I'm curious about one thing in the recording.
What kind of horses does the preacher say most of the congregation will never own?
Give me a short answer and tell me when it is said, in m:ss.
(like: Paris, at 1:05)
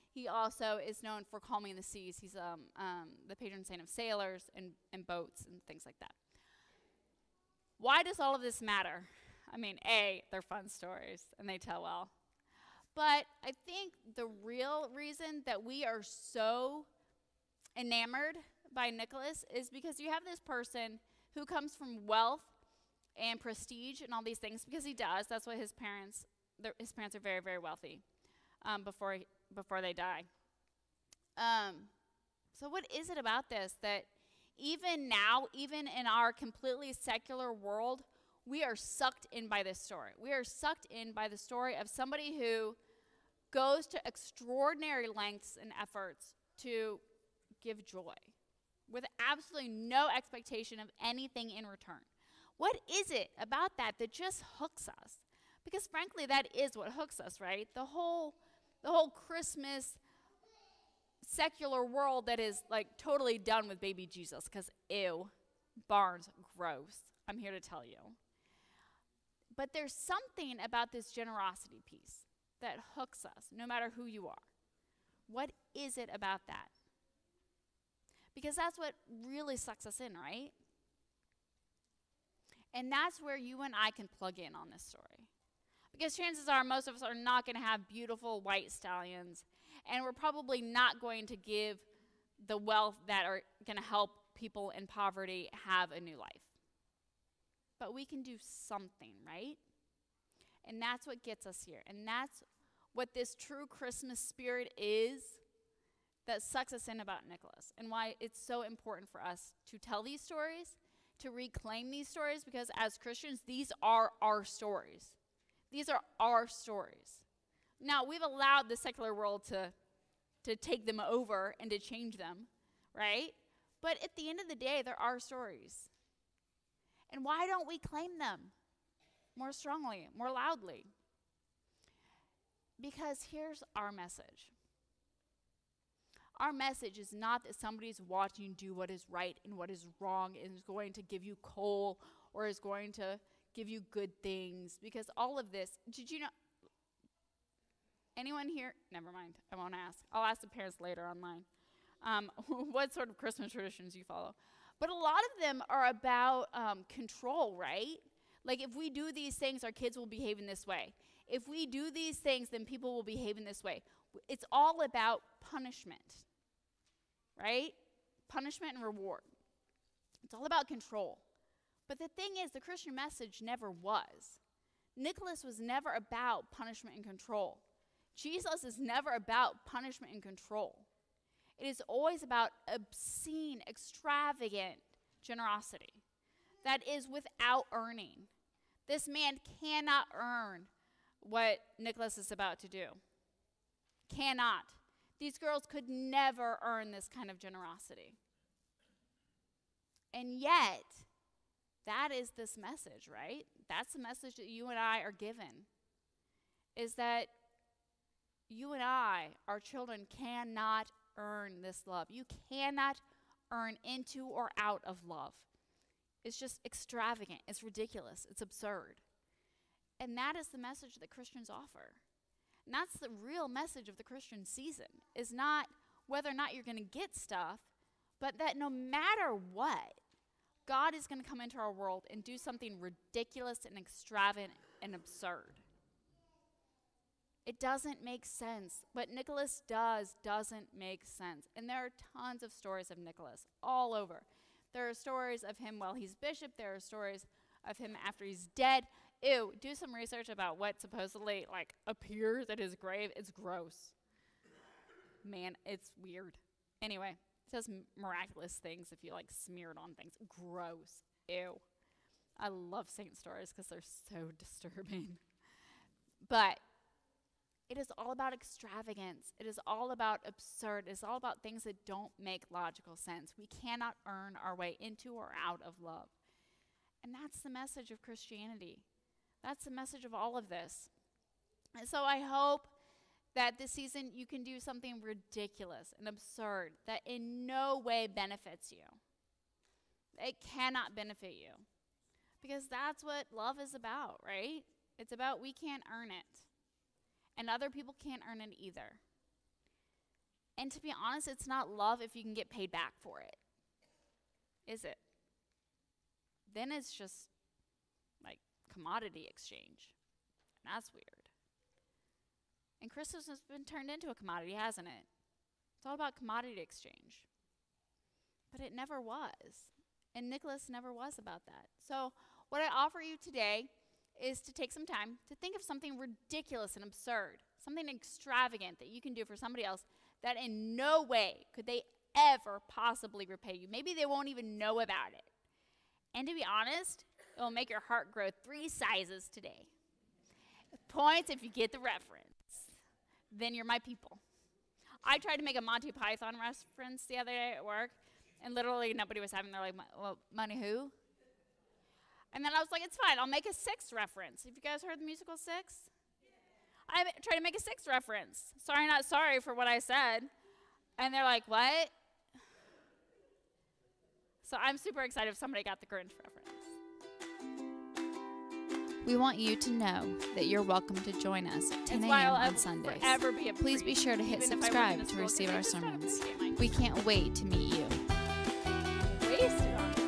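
white stallions, at 1:28.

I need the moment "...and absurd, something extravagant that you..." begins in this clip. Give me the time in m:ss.
5:26.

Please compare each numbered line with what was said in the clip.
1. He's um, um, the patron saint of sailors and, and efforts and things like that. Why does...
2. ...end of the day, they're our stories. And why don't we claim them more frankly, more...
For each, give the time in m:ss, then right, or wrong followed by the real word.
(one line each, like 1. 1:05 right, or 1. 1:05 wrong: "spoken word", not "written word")
1. 0:02 wrong: "boats", not "efforts"
2. 2:04 wrong: "strongly", not "frankly".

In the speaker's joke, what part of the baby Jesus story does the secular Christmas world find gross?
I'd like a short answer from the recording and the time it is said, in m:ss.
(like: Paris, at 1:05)
barns, at 1:05.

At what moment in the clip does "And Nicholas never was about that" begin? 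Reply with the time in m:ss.
5:20.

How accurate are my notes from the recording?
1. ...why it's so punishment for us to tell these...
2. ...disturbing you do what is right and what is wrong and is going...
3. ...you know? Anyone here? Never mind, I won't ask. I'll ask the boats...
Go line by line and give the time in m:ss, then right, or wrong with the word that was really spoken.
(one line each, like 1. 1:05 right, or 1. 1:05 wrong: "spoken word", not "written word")
1. 1:47 wrong: "important", not "punishment"
2. 2:17 wrong: "watching", not "disturbing"
3. 2:26 wrong: "parents", not "boats".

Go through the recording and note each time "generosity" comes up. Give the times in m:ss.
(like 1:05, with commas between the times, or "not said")
1:11, 3:05, 3:17.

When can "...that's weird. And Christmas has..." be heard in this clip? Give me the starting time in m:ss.
5:10.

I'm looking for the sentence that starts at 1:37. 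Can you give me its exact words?
But we can do something, right?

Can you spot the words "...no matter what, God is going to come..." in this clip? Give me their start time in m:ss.
3:48.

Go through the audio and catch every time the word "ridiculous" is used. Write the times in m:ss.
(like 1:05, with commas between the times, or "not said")
3:37, 3:52, 4:45, 5:25.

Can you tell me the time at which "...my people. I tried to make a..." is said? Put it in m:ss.
5:43.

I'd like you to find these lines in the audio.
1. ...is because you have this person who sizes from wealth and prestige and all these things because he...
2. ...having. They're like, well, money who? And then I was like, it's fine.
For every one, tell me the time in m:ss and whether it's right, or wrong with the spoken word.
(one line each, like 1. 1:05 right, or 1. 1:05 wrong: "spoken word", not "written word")
1. 0:19 wrong: "comes", not "sizes"
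2. 5:49 right.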